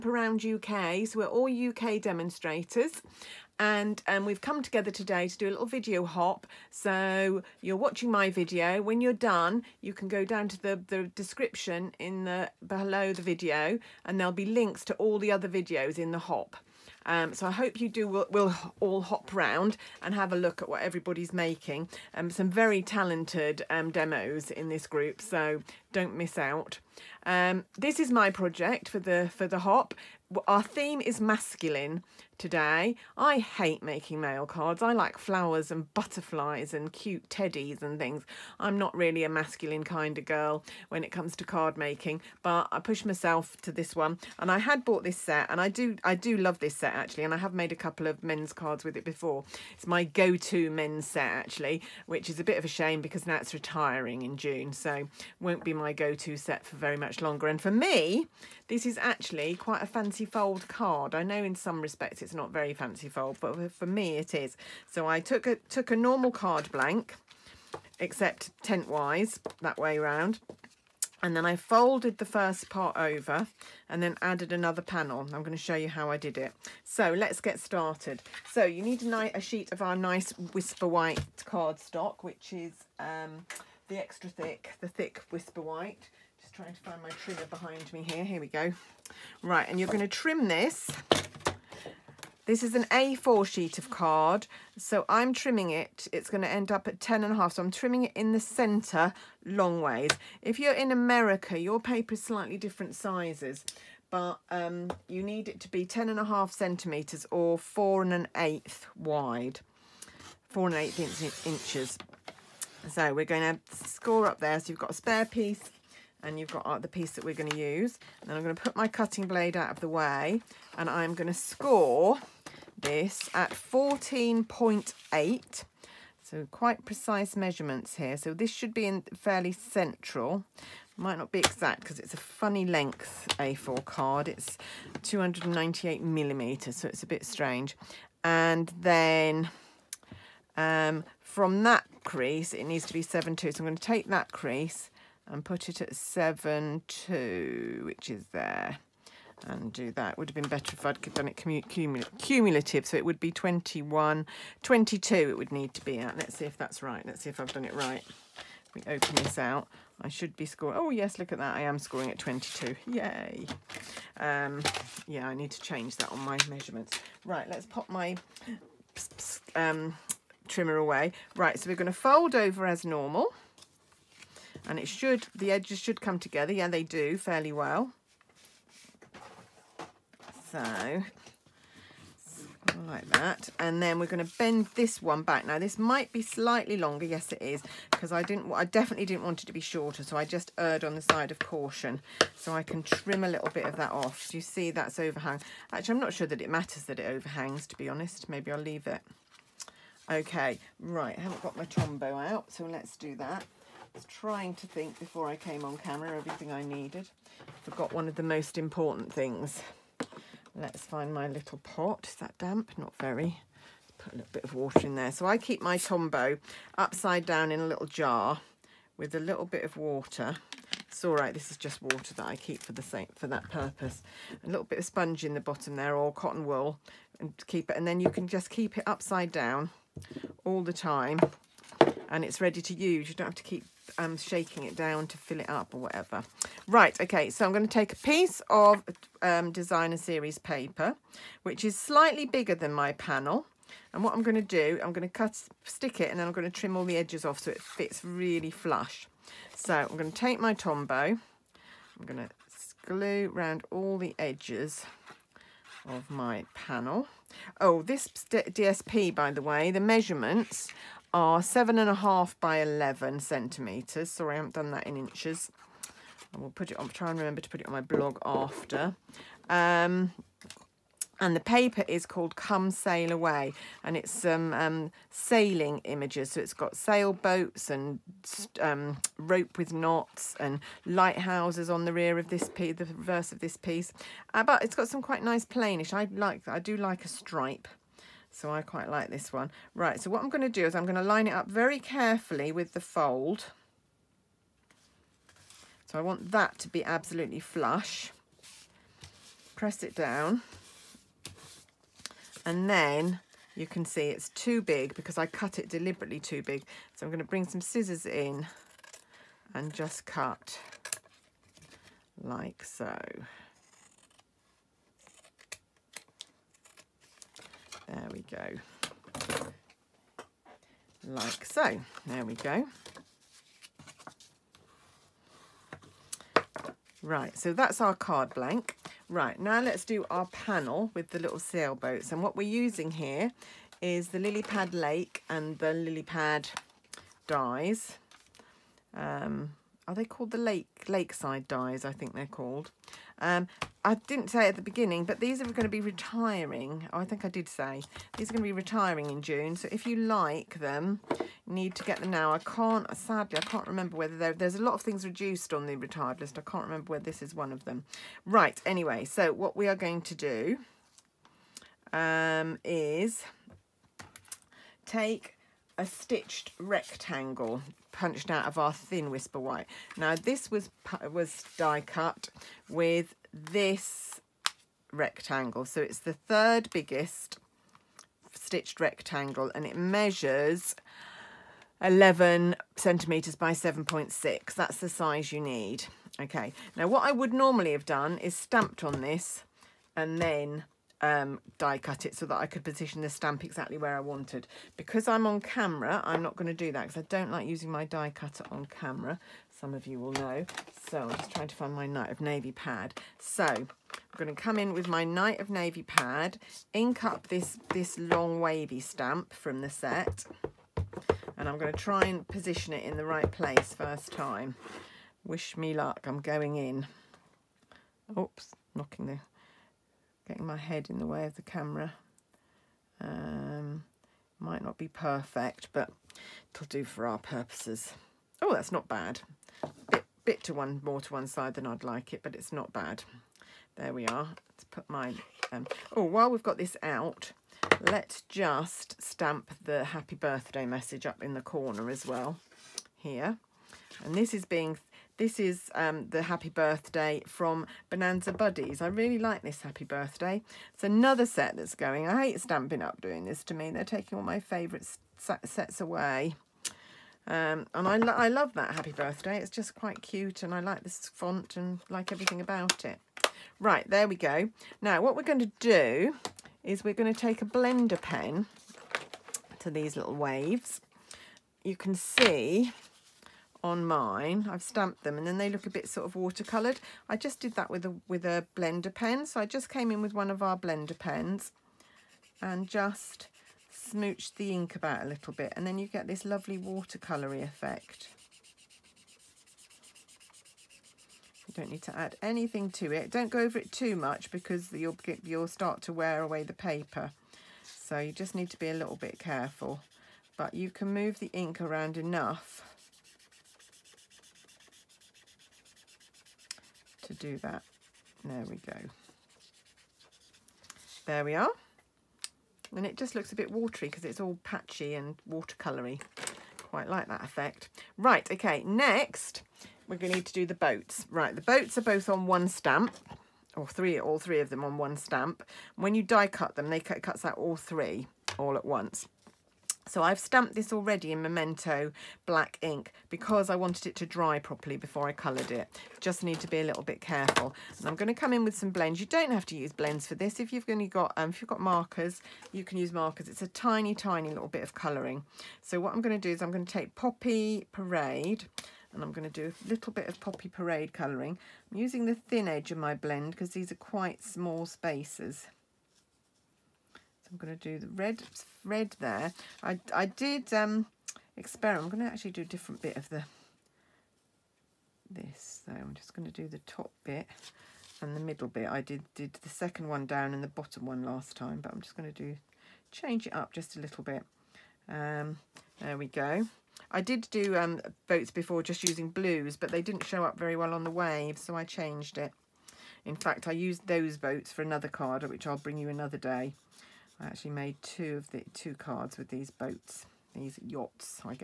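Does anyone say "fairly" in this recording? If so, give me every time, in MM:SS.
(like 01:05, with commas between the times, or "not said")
02:09, 02:57.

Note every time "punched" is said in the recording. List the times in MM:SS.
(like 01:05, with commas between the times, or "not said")
06:07.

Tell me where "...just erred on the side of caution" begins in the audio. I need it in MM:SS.
03:10.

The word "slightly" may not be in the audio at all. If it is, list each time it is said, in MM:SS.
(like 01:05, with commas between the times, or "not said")
01:42, 03:06, 04:01.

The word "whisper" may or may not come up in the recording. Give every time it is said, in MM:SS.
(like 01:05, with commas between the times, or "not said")
01:20, 01:25, 06:09.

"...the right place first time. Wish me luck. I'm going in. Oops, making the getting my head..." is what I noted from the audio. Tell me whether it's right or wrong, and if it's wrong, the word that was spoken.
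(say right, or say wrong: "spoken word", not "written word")
wrong: "knocking", not "making".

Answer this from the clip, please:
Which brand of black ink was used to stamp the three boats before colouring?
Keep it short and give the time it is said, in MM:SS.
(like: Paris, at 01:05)
Memento, at 08:51.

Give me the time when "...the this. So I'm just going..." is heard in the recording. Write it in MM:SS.
09:23.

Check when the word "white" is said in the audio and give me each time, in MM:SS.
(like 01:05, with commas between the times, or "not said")
01:20, 01:25, 06:09.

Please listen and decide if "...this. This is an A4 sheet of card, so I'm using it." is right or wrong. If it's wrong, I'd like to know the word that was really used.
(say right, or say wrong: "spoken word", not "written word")
wrong: "trimming", not "using".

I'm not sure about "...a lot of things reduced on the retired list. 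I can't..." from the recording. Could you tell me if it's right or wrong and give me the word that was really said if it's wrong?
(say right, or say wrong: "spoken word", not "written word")
right.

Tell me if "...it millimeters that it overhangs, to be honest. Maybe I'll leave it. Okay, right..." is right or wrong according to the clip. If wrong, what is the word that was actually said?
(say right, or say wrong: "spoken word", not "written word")
wrong: "matters", not "millimeters".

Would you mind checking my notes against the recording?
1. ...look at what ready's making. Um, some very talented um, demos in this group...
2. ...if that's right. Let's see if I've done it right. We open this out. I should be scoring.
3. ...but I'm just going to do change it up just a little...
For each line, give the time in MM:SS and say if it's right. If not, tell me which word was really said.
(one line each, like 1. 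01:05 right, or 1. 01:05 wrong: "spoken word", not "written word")
1. 00:20 wrong: "everybody", not "ready"
2. 02:36 right
3. 09:31 right.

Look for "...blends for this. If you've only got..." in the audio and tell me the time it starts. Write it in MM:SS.
08:59.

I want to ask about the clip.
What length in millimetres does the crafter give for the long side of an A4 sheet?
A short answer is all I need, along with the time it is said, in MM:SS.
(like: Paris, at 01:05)
298, at 02:15.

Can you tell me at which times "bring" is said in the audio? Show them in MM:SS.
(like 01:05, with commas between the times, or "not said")
05:07, 09:45.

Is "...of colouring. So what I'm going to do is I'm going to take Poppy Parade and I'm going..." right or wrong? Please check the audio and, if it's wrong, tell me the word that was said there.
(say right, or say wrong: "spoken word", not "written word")
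right.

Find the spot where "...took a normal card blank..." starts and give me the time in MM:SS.
01:05.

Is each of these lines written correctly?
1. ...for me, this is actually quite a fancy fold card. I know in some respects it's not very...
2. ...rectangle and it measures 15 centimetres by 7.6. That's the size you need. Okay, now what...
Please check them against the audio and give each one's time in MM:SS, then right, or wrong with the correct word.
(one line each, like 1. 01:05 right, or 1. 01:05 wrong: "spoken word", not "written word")
1. 00:57 right
2. 06:18 wrong: "11", not "15".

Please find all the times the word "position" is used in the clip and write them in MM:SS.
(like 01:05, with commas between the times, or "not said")
06:32, 06:52.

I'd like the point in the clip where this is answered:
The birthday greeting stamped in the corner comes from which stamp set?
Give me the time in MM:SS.
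07:27.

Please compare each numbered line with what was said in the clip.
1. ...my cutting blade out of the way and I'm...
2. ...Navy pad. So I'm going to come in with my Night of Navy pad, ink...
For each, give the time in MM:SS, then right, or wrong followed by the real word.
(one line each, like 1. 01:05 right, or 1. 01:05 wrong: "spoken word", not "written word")
1. 01:58 right
2. 06:42 right.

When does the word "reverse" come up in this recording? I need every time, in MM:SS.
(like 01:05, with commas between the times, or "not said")
04:42.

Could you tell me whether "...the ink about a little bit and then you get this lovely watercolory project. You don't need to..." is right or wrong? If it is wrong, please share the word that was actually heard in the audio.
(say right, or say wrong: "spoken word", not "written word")
wrong: "effect", not "project".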